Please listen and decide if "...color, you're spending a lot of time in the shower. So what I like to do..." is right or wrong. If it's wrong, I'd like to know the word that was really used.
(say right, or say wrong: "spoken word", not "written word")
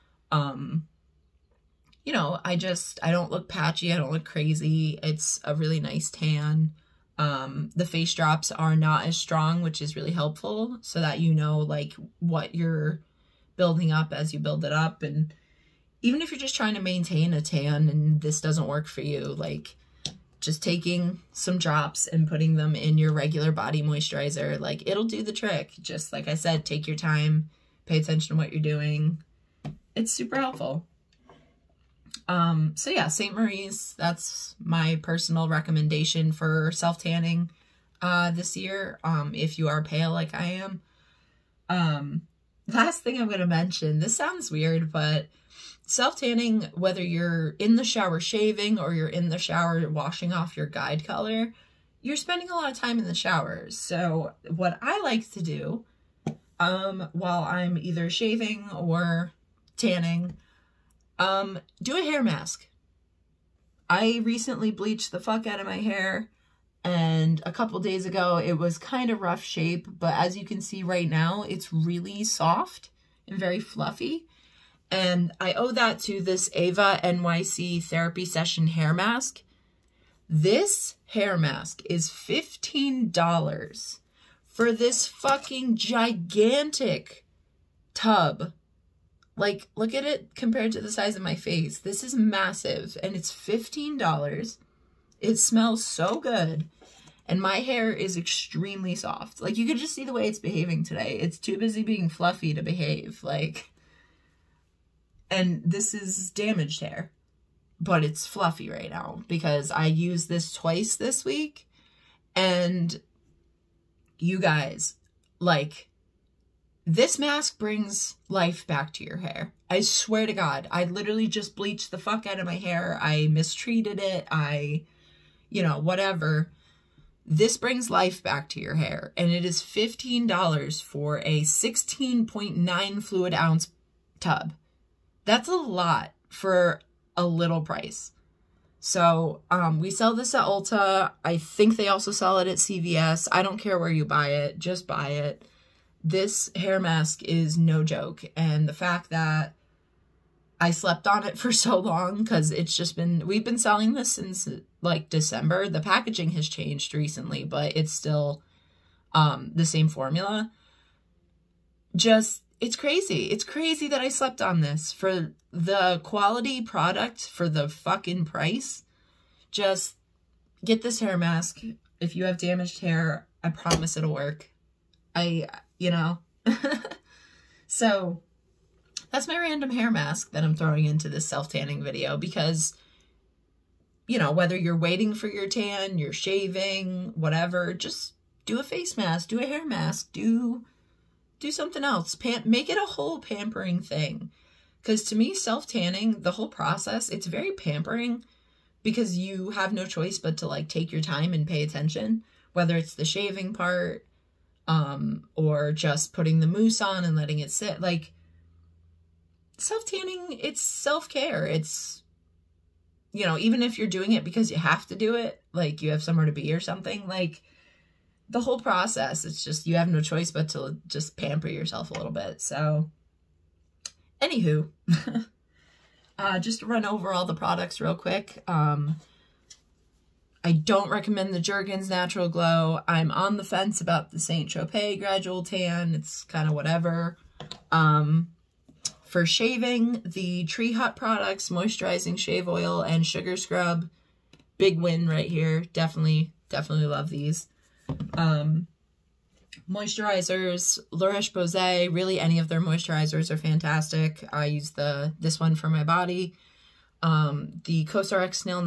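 right.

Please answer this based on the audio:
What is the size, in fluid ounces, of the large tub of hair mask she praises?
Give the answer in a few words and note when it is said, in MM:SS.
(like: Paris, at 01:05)
16.9, at 02:11.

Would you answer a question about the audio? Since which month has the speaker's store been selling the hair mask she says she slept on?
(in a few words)
December.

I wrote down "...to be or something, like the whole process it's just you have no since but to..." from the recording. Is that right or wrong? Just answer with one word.
wrong.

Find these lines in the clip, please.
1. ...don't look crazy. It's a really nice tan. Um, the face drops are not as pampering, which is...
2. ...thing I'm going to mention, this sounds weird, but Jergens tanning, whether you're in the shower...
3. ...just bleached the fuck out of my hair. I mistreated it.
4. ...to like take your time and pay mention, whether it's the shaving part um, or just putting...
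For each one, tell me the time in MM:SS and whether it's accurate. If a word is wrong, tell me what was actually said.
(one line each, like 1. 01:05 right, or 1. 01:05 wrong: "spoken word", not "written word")
1. 00:03 wrong: "strong", not "pampering"
2. 00:43 wrong: "Self", not "Jergens"
3. 02:01 right
4. 03:20 wrong: "attention", not "mention".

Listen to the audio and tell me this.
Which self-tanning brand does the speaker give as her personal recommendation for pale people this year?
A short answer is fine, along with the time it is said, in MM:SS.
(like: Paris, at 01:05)
St. Marie's, at 00:33.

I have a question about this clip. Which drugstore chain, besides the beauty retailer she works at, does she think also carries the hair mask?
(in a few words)
CVS.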